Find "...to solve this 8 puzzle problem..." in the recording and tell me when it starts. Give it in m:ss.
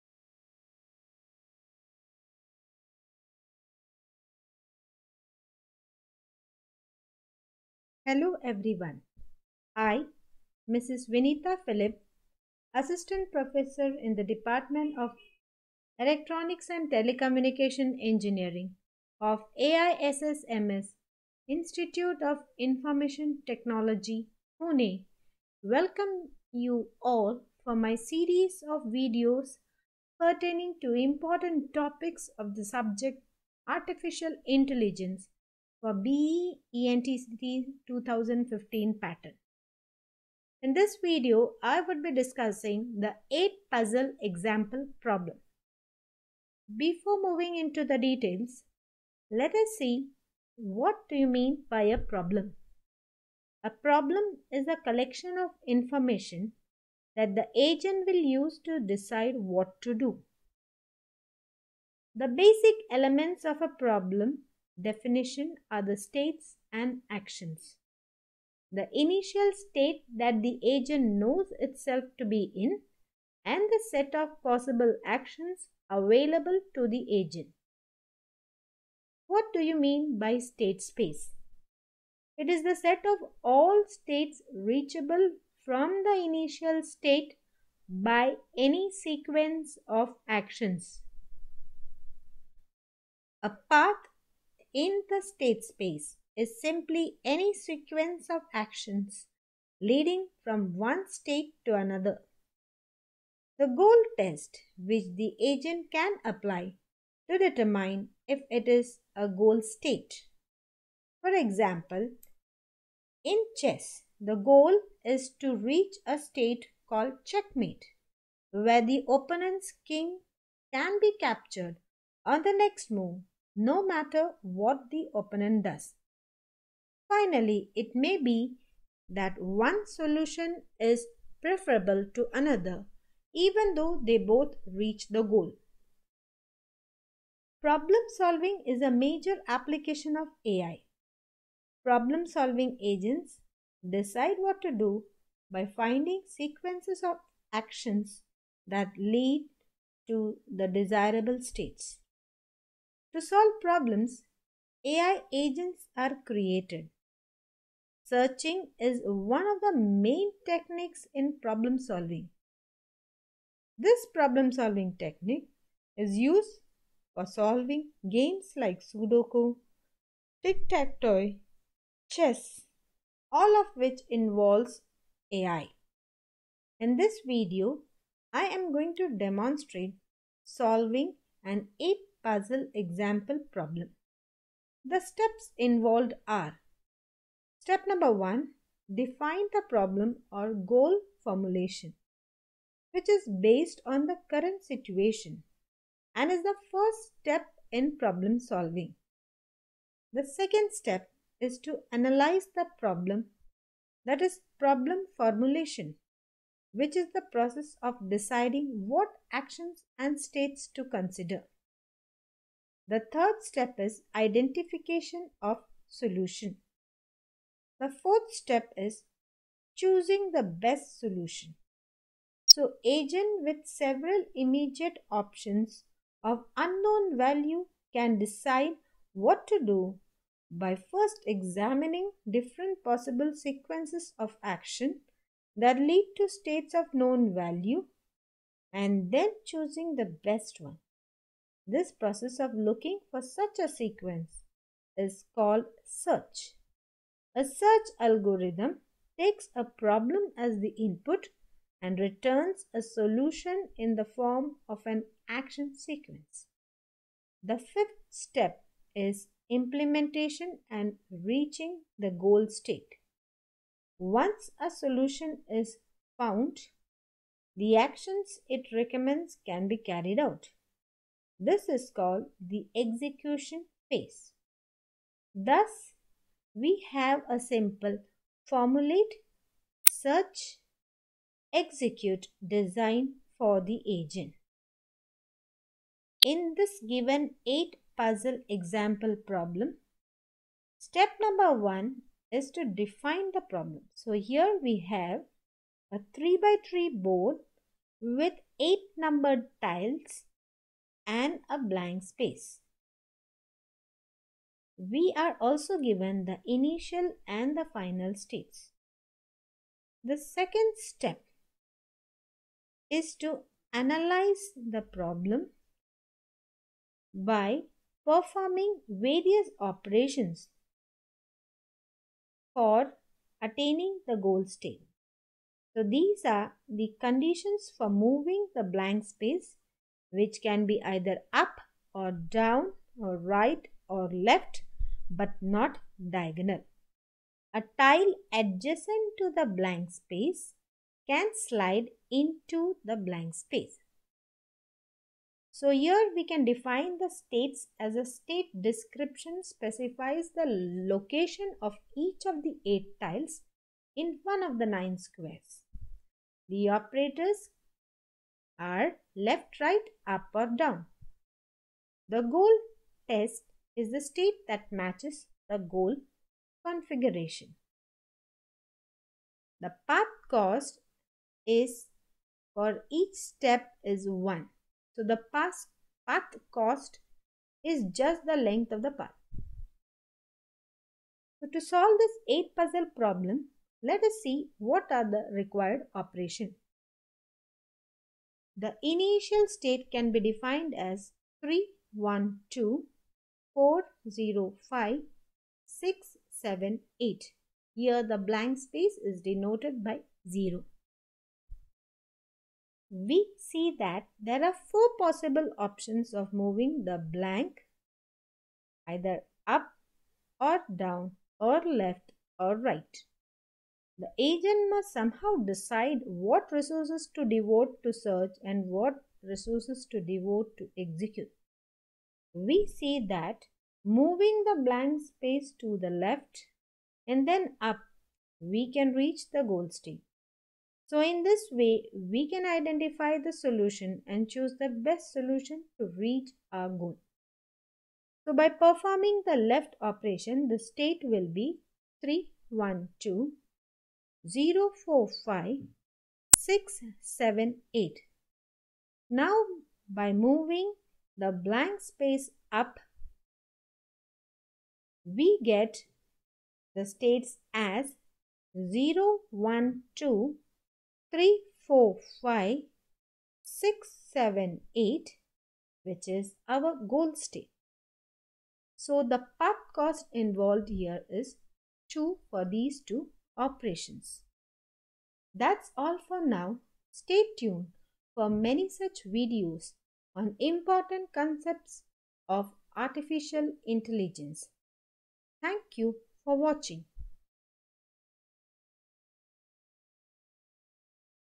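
6:21.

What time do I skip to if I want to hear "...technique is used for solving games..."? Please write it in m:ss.
2:44.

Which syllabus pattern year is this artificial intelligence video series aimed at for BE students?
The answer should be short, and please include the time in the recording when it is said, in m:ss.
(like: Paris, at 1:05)
2015, at 0:37.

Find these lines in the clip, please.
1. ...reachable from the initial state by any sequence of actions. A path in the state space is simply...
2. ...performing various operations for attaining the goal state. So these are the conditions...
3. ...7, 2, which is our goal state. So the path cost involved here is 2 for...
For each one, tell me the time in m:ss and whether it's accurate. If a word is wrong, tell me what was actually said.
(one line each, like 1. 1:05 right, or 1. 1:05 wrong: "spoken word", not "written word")
1. 1:24 right
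2. 5:18 right
3. 7:44 wrong: "8", not "2".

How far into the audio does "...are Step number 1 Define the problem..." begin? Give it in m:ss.
3:06.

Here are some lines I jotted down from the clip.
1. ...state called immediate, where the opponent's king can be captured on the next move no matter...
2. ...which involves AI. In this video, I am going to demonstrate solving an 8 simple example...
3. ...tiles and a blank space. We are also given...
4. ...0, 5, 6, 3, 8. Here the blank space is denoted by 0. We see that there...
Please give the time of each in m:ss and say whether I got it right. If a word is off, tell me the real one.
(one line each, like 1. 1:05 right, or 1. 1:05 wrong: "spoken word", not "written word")
1. 1:56 wrong: "checkmate", not "immediate"
2. 2:53 wrong: "puzzle", not "simple"
3. 4:59 right
4. 6:34 wrong: "7", not "3".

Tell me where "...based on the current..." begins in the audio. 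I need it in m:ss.
3:13.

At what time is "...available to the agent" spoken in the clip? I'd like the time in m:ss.
1:15.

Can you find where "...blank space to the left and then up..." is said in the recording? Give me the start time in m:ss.
7:04.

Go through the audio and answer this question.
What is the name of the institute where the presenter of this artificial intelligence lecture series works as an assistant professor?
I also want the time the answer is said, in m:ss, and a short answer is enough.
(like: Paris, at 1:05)
AISSMS Institute of Information Technology, at 0:19.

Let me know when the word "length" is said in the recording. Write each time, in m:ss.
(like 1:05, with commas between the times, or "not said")
6:18.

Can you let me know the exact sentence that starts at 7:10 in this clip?
So in this way, we can identify the solution and choose the best solution to reach our goal.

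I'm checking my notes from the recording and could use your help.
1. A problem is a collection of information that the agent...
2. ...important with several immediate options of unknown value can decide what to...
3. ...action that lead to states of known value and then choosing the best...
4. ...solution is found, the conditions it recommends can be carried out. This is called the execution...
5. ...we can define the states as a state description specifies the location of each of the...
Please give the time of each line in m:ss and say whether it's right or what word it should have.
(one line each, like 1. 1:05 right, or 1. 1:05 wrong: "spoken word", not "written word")
1. 0:53 right
2. 3:42 wrong: "agent", not "important"
3. 3:54 right
4. 4:24 wrong: "actions", not "conditions"
5. 5:46 right.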